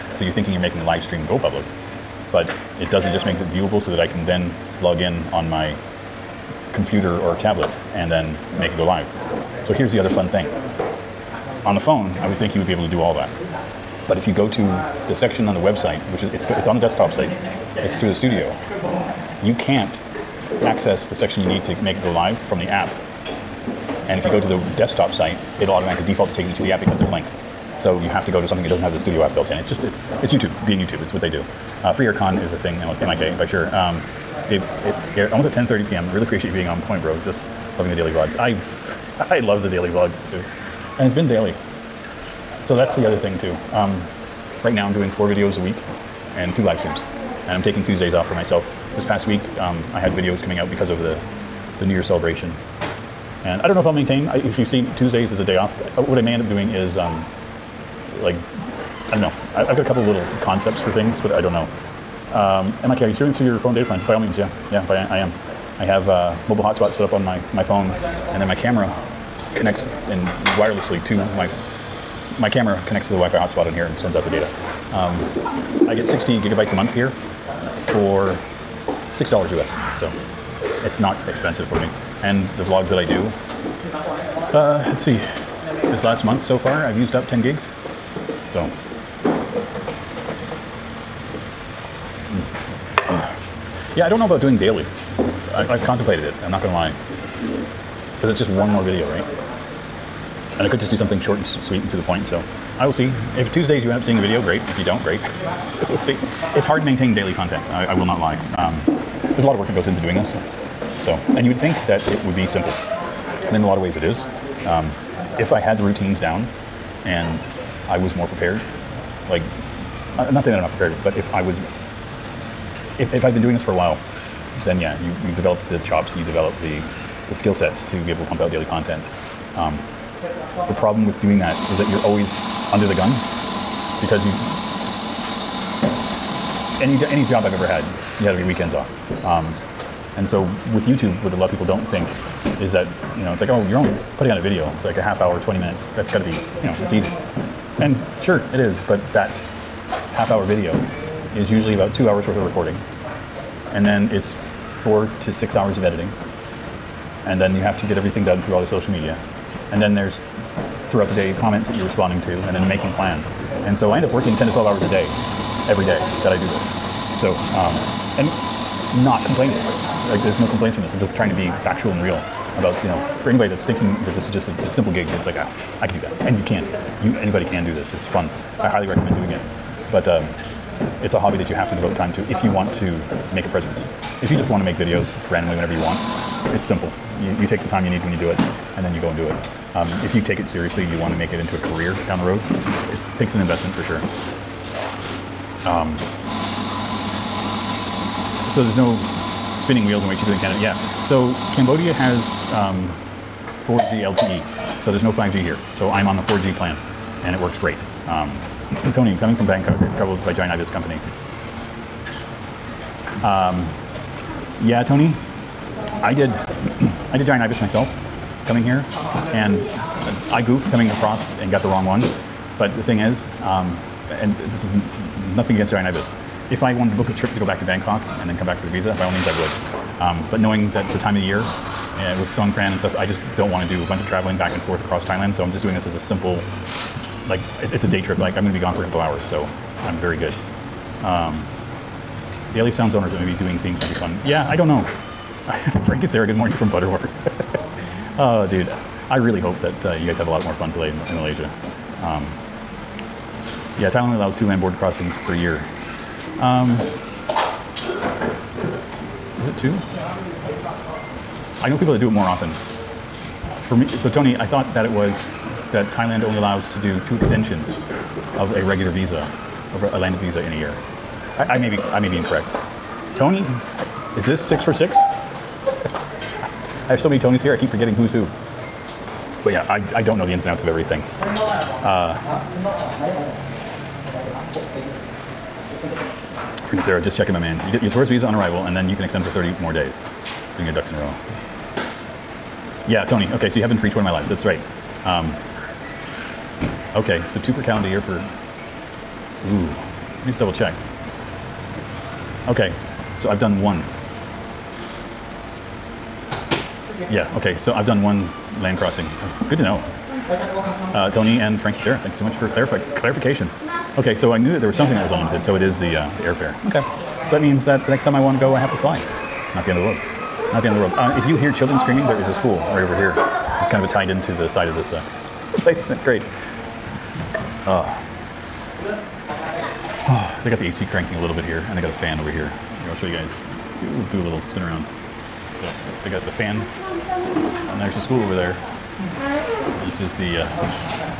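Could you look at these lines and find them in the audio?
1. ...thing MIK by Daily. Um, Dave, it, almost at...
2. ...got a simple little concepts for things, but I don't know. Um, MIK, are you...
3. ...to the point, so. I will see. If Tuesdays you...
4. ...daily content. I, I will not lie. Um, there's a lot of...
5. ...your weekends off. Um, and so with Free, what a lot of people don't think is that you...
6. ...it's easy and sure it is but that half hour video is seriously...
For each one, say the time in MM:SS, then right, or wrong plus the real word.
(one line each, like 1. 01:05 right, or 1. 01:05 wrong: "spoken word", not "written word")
1. 00:32 wrong: "Sure", not "Daily"
2. 00:59 wrong: "couple", not "simple"
3. 01:41 right
4. 01:47 right
5. 02:18 wrong: "YouTube", not "Free"
6. 02:26 wrong: "usually", not "seriously".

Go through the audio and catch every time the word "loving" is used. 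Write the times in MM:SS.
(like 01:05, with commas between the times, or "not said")
00:37.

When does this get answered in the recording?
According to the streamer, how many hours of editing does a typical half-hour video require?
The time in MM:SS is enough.
02:34.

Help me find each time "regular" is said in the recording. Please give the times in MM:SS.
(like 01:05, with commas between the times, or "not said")
04:28.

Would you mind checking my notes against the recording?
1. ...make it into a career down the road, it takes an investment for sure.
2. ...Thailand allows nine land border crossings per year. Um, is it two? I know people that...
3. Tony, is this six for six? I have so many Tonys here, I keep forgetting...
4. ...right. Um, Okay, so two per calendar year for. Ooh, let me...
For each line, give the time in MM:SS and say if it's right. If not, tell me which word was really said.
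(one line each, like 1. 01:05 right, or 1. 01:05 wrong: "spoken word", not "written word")
1. 03:11 right
2. 04:13 wrong: "two", not "nine"
3. 04:33 right
4. 04:54 right.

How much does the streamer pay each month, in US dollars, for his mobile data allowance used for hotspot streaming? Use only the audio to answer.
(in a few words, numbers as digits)
$6.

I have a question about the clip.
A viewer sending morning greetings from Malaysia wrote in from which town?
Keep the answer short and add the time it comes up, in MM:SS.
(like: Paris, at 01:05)
Butterworth, at 04:06.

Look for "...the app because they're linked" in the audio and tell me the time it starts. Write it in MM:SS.
00:26.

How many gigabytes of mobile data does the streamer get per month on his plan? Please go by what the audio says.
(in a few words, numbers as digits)
60.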